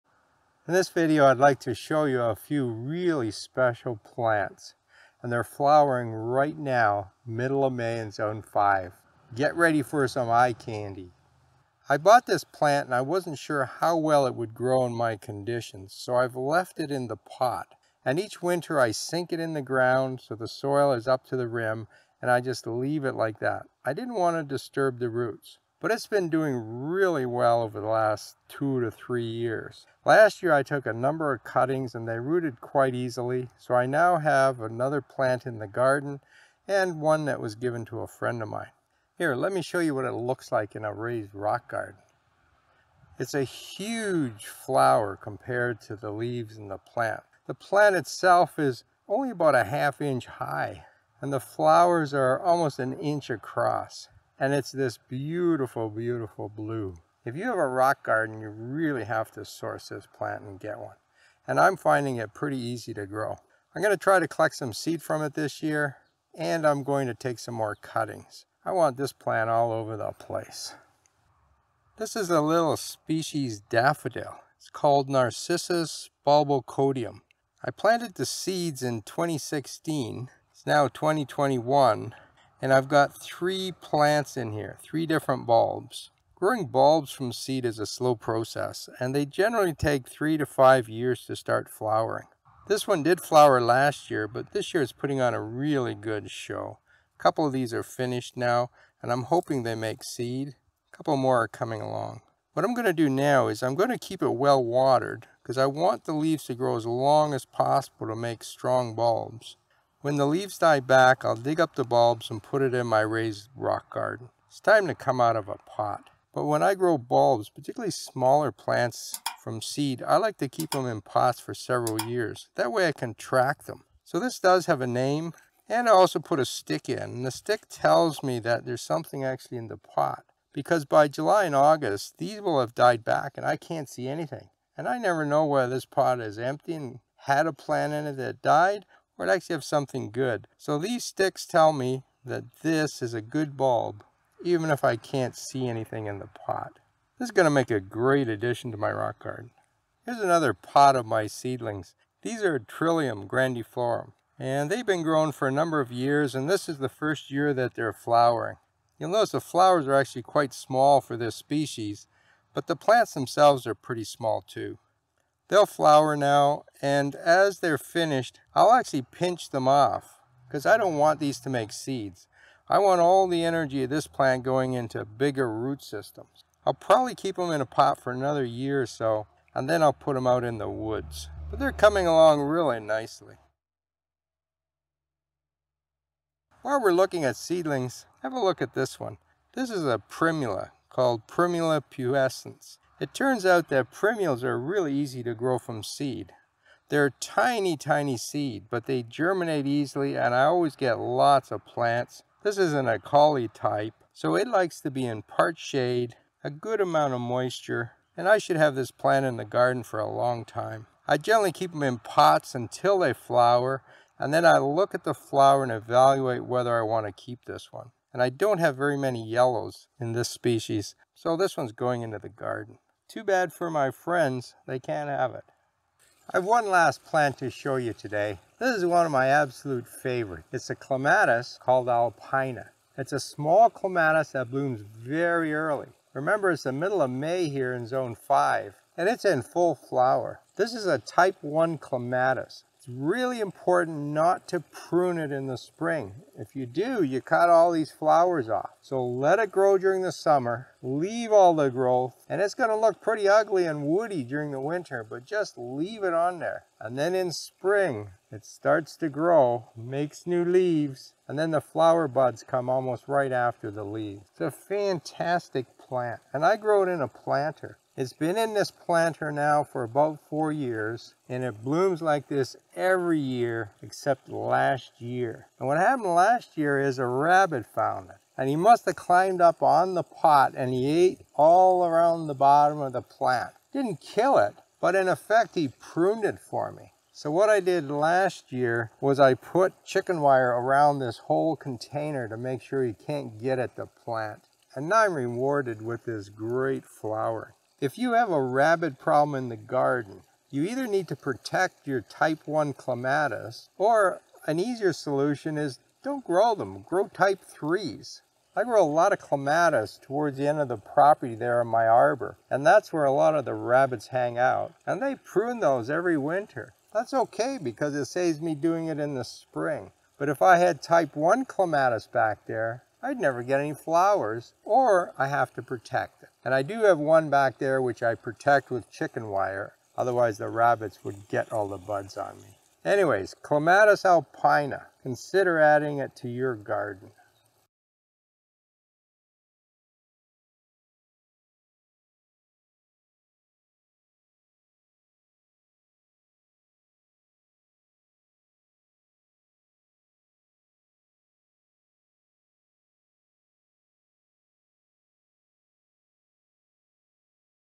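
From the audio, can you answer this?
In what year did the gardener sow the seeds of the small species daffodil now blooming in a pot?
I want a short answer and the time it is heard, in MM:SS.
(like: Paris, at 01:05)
2016, at 01:19.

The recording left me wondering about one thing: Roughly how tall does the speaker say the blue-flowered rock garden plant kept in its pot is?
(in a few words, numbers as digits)
half inch.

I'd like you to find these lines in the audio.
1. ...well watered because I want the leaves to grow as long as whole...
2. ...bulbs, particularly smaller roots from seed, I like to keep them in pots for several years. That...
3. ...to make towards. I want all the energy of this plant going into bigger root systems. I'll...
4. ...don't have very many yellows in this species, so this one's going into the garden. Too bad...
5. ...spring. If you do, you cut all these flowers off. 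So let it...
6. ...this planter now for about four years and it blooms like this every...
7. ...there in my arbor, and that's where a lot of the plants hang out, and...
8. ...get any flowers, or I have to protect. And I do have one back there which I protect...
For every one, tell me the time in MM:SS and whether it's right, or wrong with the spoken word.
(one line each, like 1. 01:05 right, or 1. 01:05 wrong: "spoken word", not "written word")
1. 01:44 wrong: "possible", not "whole"
2. 01:56 wrong: "plants", not "roots"
3. 02:51 wrong: "seeds", not "towards"
4. 03:38 right
5. 04:05 right
6. 04:28 right
7. 05:11 wrong: "rabbits", not "plants"
8. 05:23 right.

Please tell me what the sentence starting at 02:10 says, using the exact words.
Because by July and August, these will have died back and I can't see anything.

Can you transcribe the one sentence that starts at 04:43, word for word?
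Didn't kill it, but in effect he pruned it for me.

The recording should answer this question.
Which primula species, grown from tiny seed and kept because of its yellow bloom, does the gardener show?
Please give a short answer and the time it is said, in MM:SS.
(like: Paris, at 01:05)
Primula pubescens, at 03:11.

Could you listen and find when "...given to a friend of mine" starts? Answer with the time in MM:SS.
00:37.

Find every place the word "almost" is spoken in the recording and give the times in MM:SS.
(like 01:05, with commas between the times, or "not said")
00:52, 04:22.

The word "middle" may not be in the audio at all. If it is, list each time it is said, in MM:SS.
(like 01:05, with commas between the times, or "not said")
00:07, 03:56.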